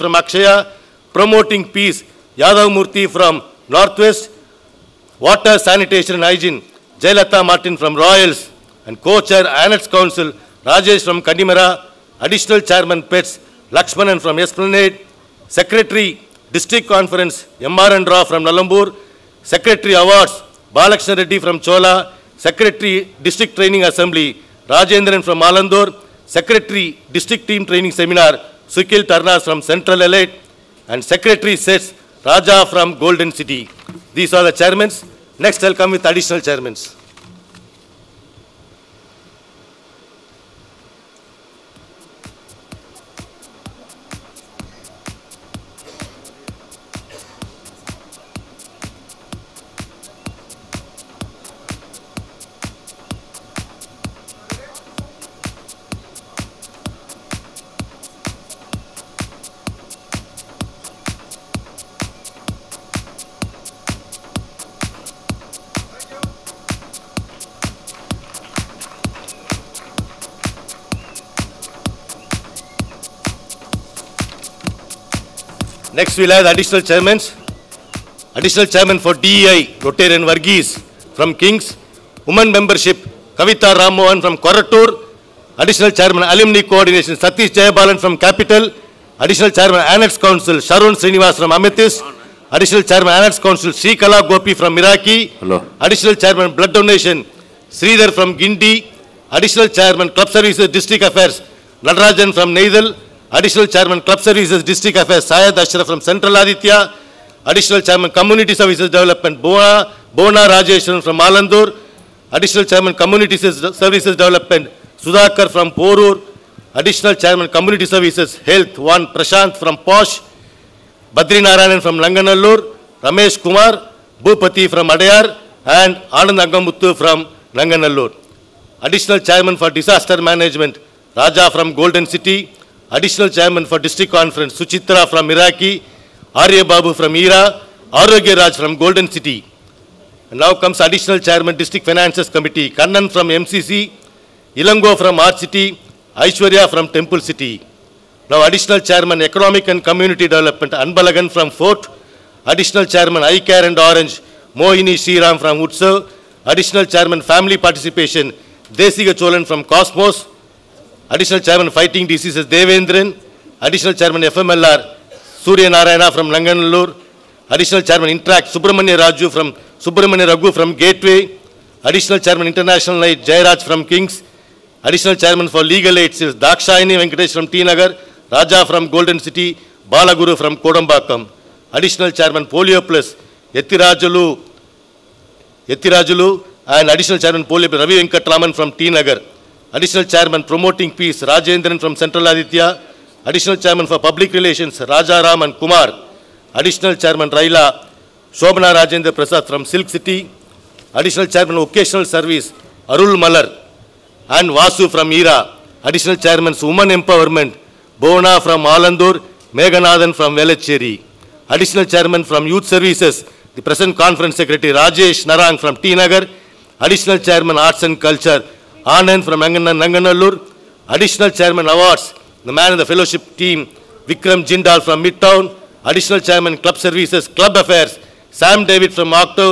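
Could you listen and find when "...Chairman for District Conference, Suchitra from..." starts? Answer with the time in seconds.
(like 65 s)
133 s.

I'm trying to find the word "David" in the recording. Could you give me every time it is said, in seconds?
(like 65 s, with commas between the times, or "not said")
228 s.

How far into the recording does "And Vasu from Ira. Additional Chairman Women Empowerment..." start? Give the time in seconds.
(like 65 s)
204 s.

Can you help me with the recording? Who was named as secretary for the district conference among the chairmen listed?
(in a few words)
Lakshmanan.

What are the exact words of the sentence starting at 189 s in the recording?
Additional Chairman Promoting Peace, Rajendran from Central Aditya.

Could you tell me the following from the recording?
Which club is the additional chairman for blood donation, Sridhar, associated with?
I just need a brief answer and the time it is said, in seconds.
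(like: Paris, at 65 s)
Gindi, at 98 s.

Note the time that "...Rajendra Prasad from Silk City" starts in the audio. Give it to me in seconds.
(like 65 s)
198 s.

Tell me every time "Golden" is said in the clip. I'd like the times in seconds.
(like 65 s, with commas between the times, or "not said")
32 s, 131 s, 138 s, 178 s.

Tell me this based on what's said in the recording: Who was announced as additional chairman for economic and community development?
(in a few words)
Anbalagan.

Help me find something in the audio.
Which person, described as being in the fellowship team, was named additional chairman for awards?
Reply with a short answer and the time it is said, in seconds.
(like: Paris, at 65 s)
Vikram Jindal, at 224 s.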